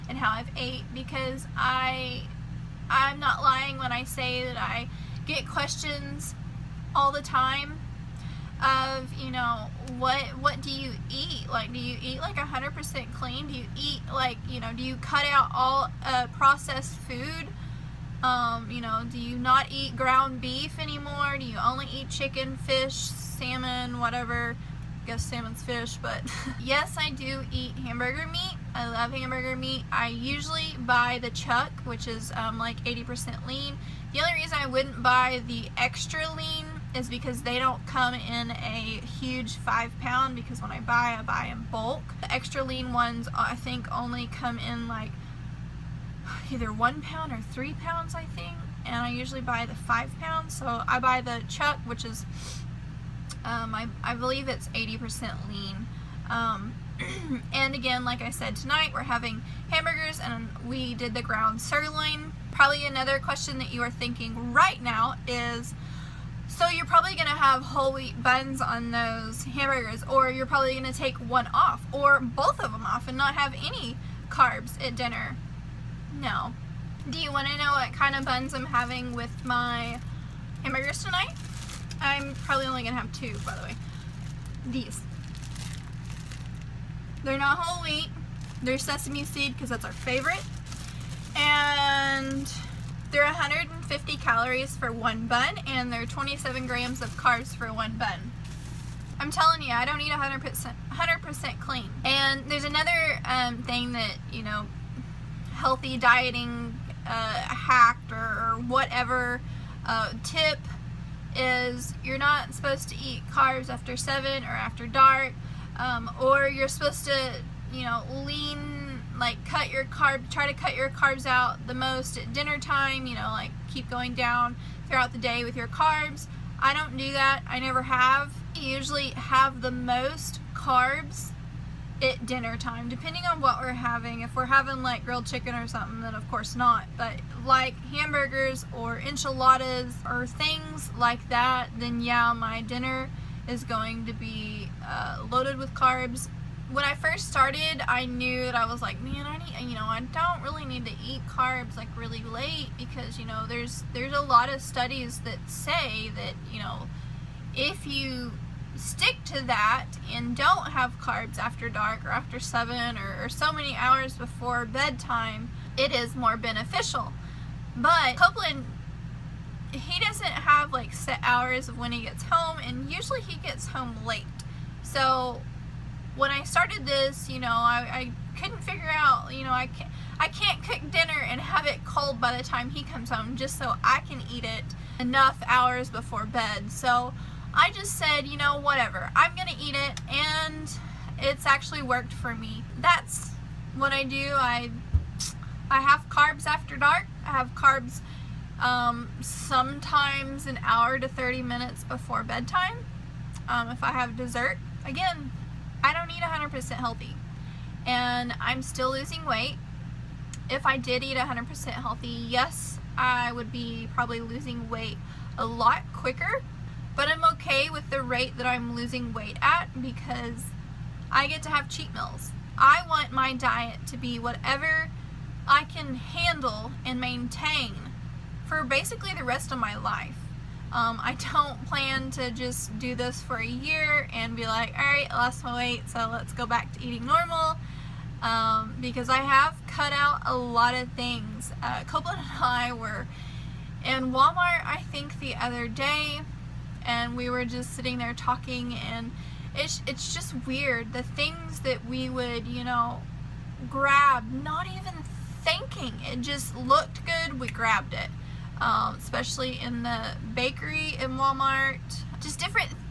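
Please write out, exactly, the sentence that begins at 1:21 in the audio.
I'm probably only going to have two, by the way.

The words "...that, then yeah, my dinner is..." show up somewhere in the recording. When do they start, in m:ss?
2:21.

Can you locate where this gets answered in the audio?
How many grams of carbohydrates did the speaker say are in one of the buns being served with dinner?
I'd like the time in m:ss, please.
1:36.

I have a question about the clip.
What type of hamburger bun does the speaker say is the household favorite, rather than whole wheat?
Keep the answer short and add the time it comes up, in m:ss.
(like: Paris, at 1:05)
sesame seed, at 1:28.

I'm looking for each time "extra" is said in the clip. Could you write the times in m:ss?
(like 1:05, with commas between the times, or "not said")
0:35, 0:42.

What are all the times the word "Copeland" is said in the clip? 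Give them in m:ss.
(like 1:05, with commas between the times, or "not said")
2:48, 4:01.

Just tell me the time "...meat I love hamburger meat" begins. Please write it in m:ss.
0:28.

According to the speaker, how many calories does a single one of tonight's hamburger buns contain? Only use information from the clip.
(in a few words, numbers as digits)
150 calories.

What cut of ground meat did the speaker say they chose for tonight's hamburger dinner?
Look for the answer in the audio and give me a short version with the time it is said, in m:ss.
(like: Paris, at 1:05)
ground sirloin, at 1:01.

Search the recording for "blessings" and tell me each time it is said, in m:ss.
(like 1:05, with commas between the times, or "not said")
not said.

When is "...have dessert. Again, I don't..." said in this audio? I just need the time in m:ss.
3:23.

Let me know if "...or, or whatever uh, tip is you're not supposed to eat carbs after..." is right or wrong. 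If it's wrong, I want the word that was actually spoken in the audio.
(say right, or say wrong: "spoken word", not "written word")
right.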